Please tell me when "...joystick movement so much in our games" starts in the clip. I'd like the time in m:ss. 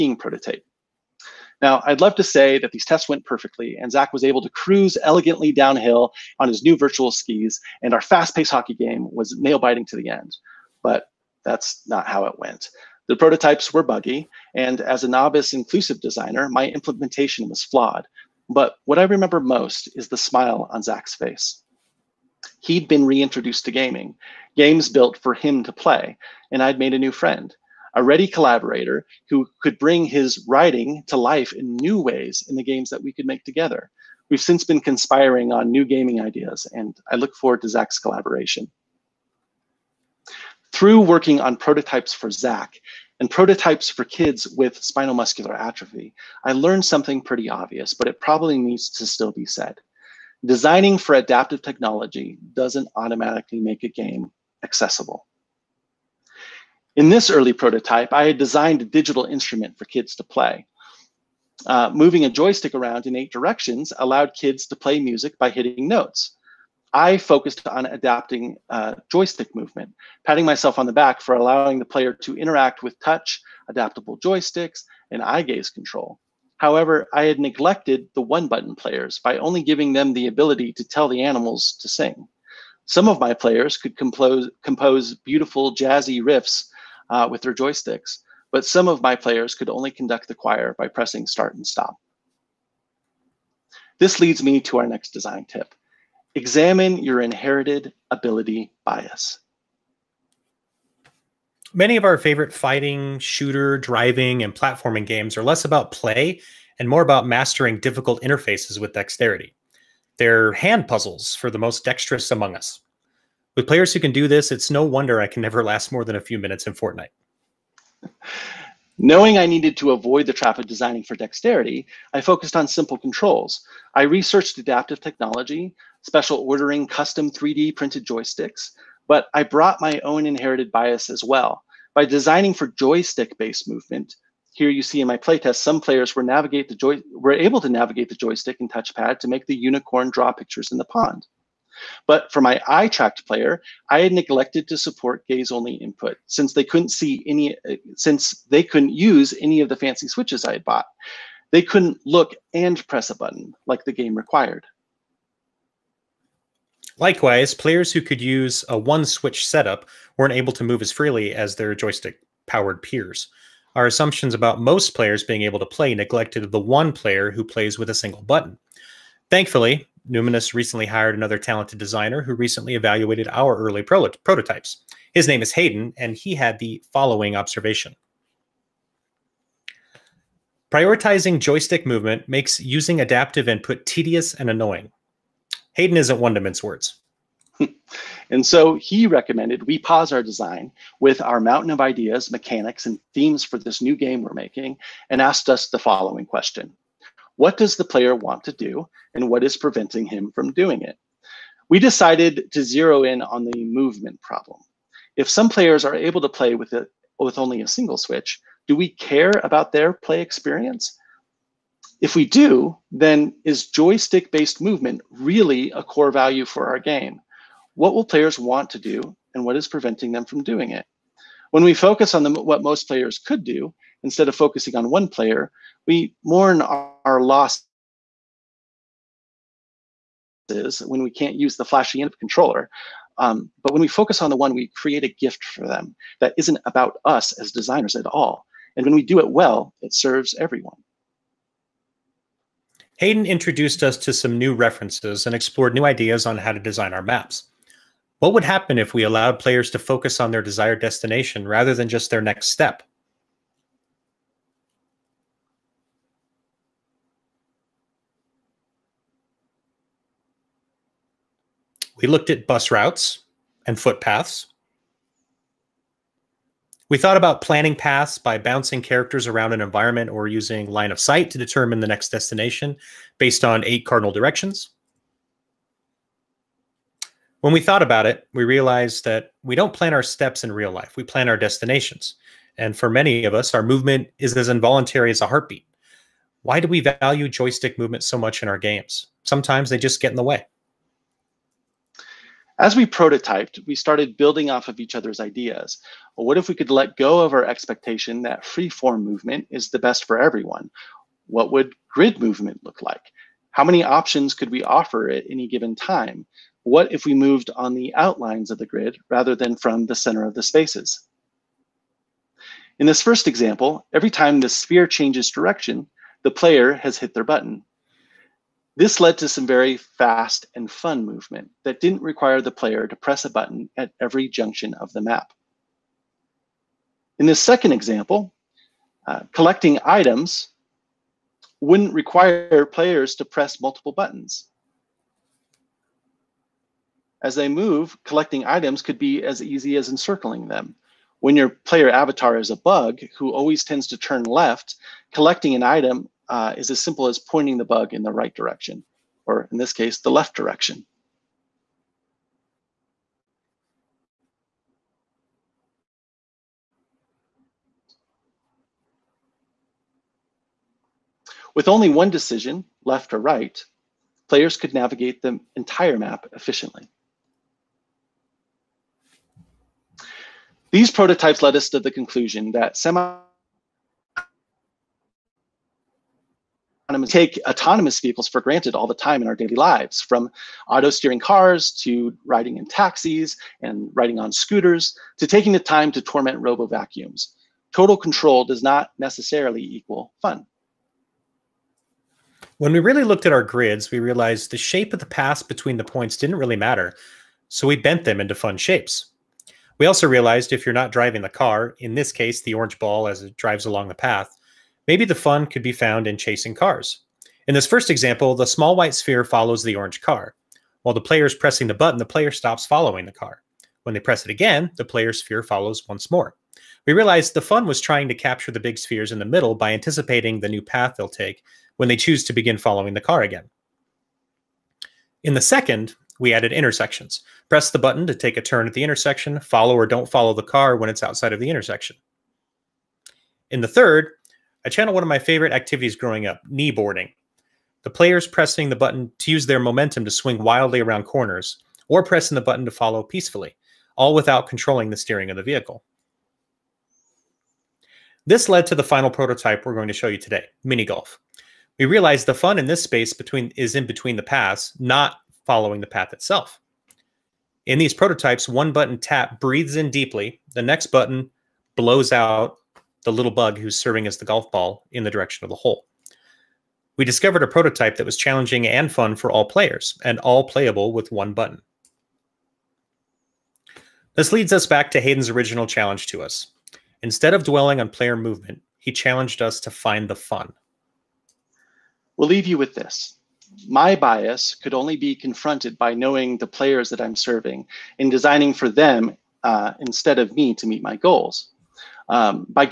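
4:47.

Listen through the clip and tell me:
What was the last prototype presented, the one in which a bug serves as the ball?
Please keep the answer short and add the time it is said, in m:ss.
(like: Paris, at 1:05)
Mini golf, at 7:30.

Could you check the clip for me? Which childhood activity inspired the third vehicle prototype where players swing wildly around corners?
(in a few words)
Kneeboarding.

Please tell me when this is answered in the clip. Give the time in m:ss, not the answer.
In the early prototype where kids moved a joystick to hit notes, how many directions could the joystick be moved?
1:03.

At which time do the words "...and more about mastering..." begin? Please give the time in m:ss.
1:46.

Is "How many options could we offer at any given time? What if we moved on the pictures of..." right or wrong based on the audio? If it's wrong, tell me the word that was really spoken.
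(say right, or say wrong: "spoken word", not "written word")
wrong: "outlines", not "pictures".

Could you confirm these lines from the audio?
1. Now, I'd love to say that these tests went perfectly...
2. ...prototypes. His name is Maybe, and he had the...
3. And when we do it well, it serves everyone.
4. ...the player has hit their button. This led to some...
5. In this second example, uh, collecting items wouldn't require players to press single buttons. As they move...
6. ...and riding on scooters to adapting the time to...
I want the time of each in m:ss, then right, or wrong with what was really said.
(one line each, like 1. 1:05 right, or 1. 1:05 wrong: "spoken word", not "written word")
1. 0:01 right
2. 2:54 wrong: "Hayden", not "Maybe"
3. 3:58 right
4. 5:16 right
5. 5:27 wrong: "multiple", not "single"
6. 6:23 wrong: "taking", not "adapting".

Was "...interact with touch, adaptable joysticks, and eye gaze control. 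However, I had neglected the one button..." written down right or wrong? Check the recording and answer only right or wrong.
right.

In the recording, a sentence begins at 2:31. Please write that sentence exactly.
They couldn't look and press a button like the game required.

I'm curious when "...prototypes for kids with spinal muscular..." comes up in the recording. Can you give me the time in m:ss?
0:43.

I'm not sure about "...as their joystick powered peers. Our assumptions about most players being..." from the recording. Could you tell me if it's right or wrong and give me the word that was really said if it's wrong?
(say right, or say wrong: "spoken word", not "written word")
right.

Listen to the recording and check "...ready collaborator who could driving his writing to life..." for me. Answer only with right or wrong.
wrong.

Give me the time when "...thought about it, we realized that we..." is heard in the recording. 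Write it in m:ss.
4:37.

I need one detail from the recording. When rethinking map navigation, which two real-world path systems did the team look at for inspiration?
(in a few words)
Bus routes and footpaths.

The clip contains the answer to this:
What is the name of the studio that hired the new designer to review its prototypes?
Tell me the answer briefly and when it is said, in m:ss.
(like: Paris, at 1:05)
Numinous, at 2:50.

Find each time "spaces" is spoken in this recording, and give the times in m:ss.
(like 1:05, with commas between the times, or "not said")
5:10, 7:32.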